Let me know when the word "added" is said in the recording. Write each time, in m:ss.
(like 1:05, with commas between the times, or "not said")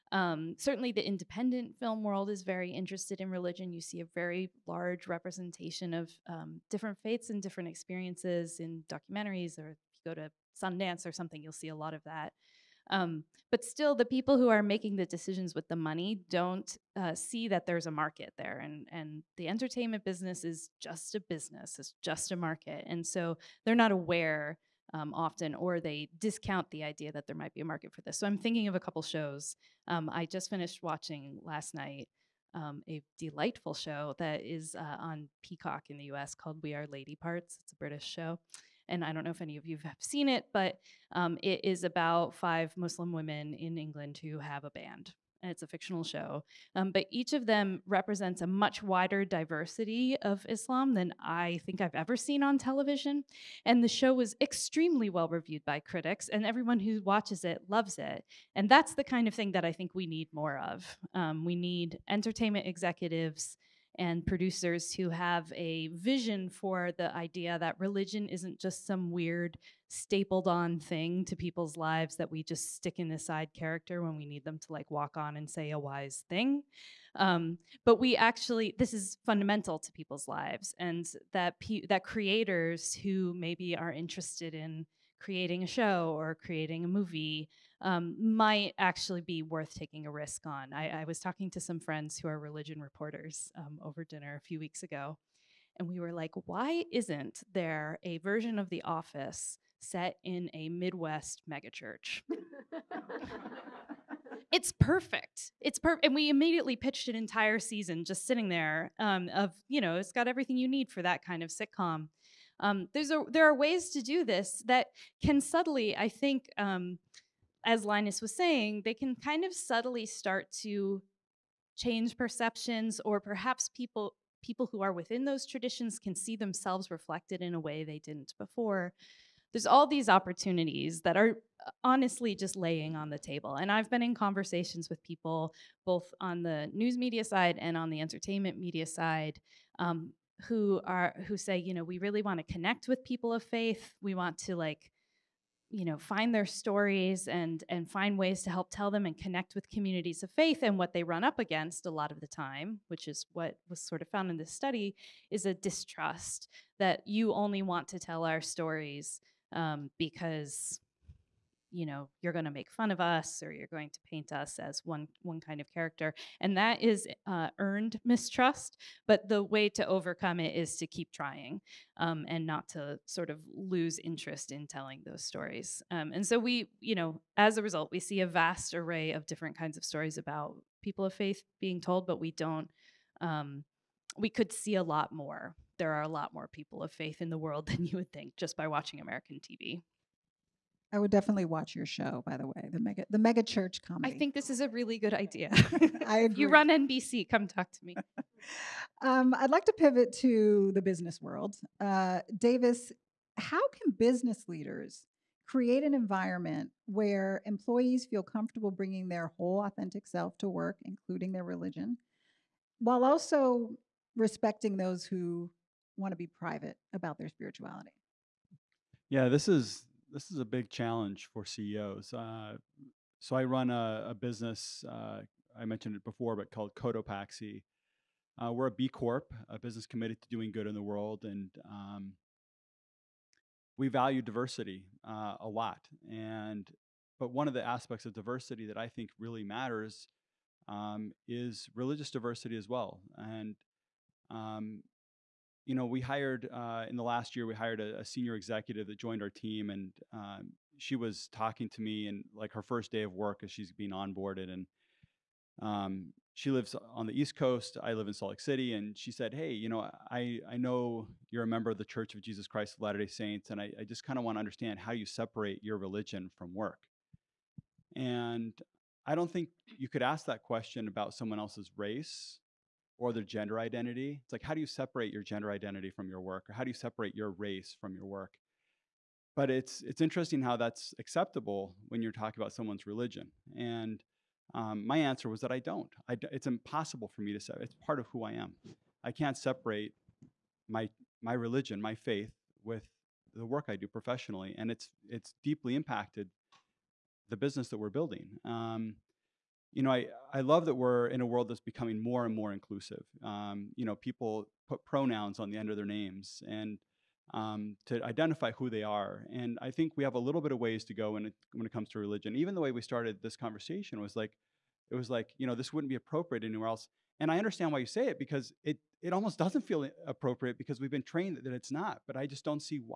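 not said.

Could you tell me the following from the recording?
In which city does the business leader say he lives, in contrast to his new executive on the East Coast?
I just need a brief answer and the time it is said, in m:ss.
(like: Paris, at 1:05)
Salt Lake City, at 4:18.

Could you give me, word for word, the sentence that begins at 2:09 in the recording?
There's all these opportunities that are uh, honestly just laying on the table.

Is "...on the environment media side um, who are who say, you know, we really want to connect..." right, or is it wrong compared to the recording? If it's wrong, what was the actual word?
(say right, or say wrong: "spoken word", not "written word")
wrong: "entertainment", not "environment".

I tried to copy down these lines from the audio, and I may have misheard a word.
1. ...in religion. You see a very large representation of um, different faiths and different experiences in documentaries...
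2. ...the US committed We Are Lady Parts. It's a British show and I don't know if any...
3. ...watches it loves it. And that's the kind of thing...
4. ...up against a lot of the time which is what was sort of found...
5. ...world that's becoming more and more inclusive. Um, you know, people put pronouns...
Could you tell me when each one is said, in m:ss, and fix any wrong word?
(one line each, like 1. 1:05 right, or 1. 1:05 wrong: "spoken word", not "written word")
1. 0:03 right
2. 0:35 wrong: "called", not "committed"
3. 0:57 right
4. 2:31 right
5. 5:01 right.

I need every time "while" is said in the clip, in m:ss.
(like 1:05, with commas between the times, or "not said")
3:32.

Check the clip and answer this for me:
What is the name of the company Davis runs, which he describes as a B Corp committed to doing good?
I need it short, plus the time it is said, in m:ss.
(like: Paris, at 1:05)
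Cotopaxi, at 3:46.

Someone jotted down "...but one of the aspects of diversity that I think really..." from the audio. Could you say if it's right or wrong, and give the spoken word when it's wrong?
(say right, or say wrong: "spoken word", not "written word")
right.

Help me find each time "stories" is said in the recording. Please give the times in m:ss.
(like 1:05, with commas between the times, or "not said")
2:26, 2:38, 2:55, 2:59.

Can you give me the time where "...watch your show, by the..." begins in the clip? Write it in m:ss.
3:11.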